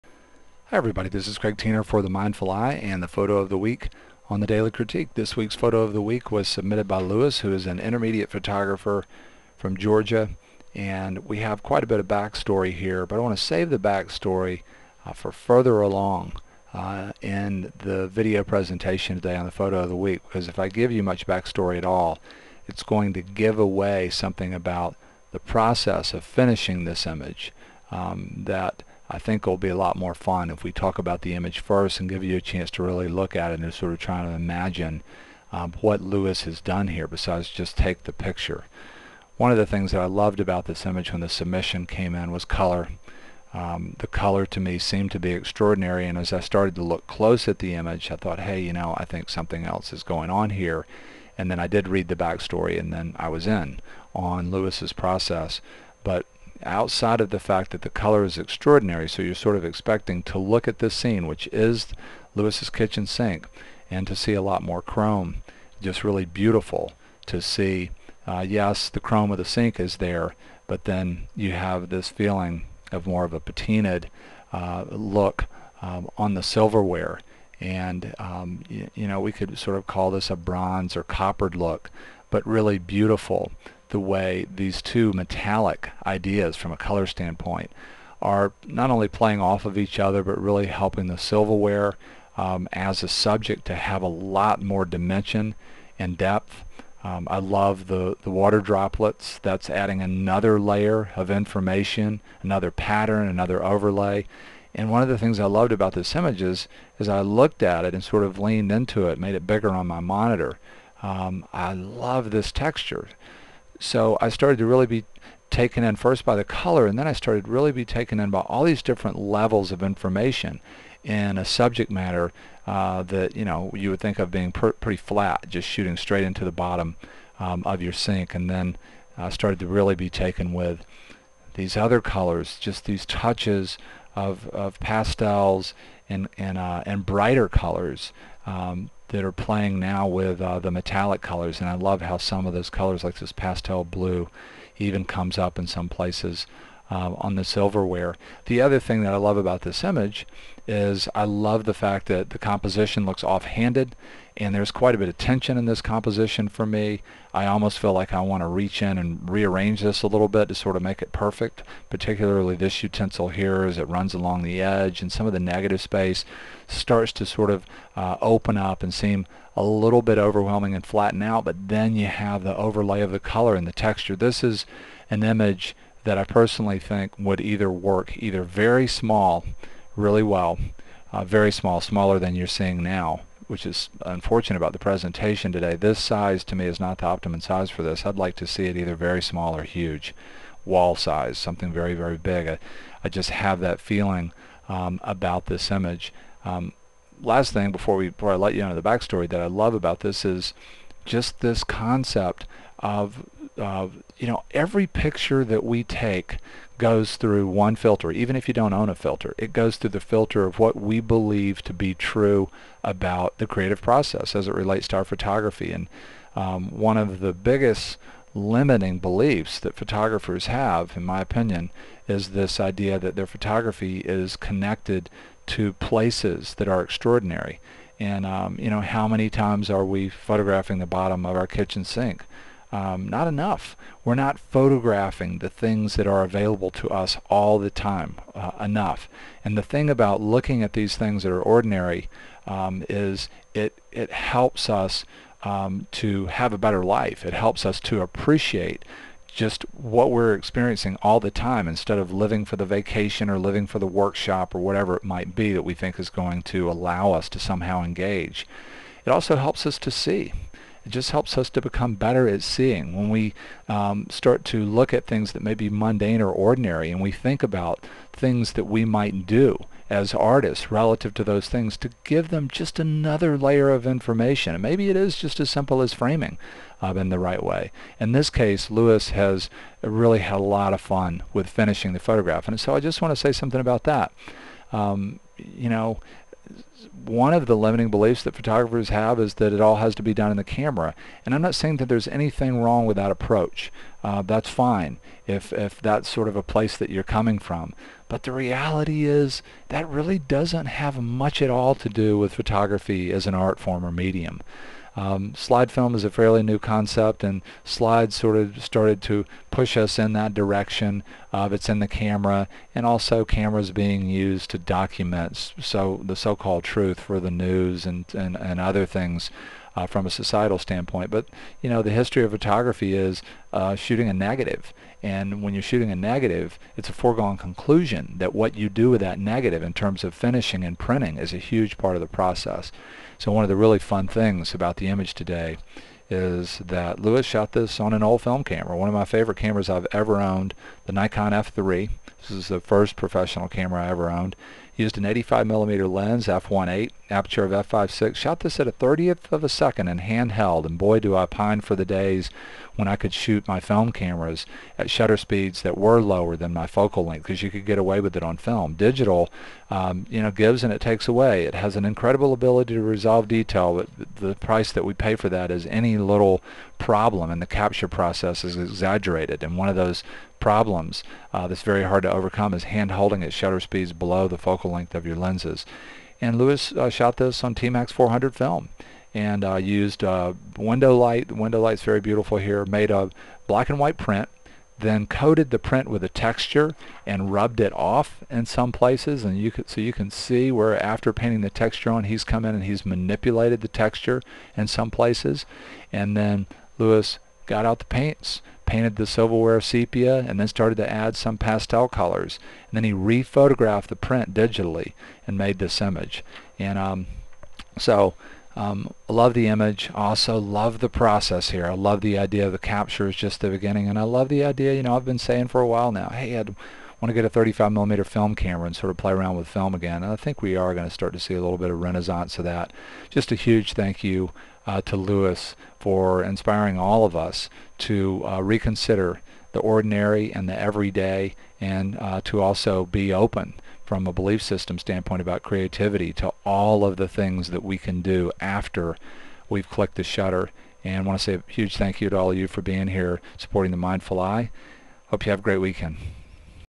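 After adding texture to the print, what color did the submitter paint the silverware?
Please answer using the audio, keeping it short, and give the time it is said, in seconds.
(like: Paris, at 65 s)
sepia, at 399 s.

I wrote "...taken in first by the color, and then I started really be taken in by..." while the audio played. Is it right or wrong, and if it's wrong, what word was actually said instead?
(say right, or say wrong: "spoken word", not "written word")
right.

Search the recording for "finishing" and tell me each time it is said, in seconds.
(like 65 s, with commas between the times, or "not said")
26 s, 281 s, 330 s.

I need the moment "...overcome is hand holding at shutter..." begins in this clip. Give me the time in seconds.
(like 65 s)
372 s.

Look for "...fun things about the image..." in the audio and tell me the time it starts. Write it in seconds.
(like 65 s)
333 s.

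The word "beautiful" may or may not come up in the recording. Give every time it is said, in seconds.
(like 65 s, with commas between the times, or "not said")
66 s, 82 s, 381 s.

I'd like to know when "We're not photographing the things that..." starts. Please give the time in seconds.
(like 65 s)
234 s.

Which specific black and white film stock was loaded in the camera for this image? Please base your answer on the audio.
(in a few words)
T-Max 400.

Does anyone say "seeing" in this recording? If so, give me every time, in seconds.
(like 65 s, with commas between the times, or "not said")
182 s, 262 s.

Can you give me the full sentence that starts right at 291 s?
And I'm not saying that there's anything wrong with that approach.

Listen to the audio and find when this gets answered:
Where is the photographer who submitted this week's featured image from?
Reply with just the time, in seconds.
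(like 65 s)
9 s.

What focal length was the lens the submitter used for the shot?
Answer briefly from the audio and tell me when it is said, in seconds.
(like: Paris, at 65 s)
85 millimeter, at 345 s.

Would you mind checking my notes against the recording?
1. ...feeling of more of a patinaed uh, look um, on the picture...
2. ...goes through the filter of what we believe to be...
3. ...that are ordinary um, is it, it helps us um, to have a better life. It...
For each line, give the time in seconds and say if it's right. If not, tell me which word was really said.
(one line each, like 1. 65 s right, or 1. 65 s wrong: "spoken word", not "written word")
1. 72 s wrong: "silverware", not "picture"
2. 209 s right
3. 241 s right.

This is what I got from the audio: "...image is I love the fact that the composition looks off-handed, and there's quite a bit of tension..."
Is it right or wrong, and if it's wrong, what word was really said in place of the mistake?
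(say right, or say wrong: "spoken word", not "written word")
right.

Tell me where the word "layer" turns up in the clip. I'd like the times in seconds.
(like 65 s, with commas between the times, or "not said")
100 s, 273 s.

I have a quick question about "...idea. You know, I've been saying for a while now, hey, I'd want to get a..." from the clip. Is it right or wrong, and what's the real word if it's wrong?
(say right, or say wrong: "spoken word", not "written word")
right.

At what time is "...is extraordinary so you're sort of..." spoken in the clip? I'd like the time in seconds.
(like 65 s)
58 s.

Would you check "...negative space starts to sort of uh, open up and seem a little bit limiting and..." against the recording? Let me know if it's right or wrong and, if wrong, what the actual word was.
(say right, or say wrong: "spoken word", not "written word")
wrong: "overwhelming", not "limiting".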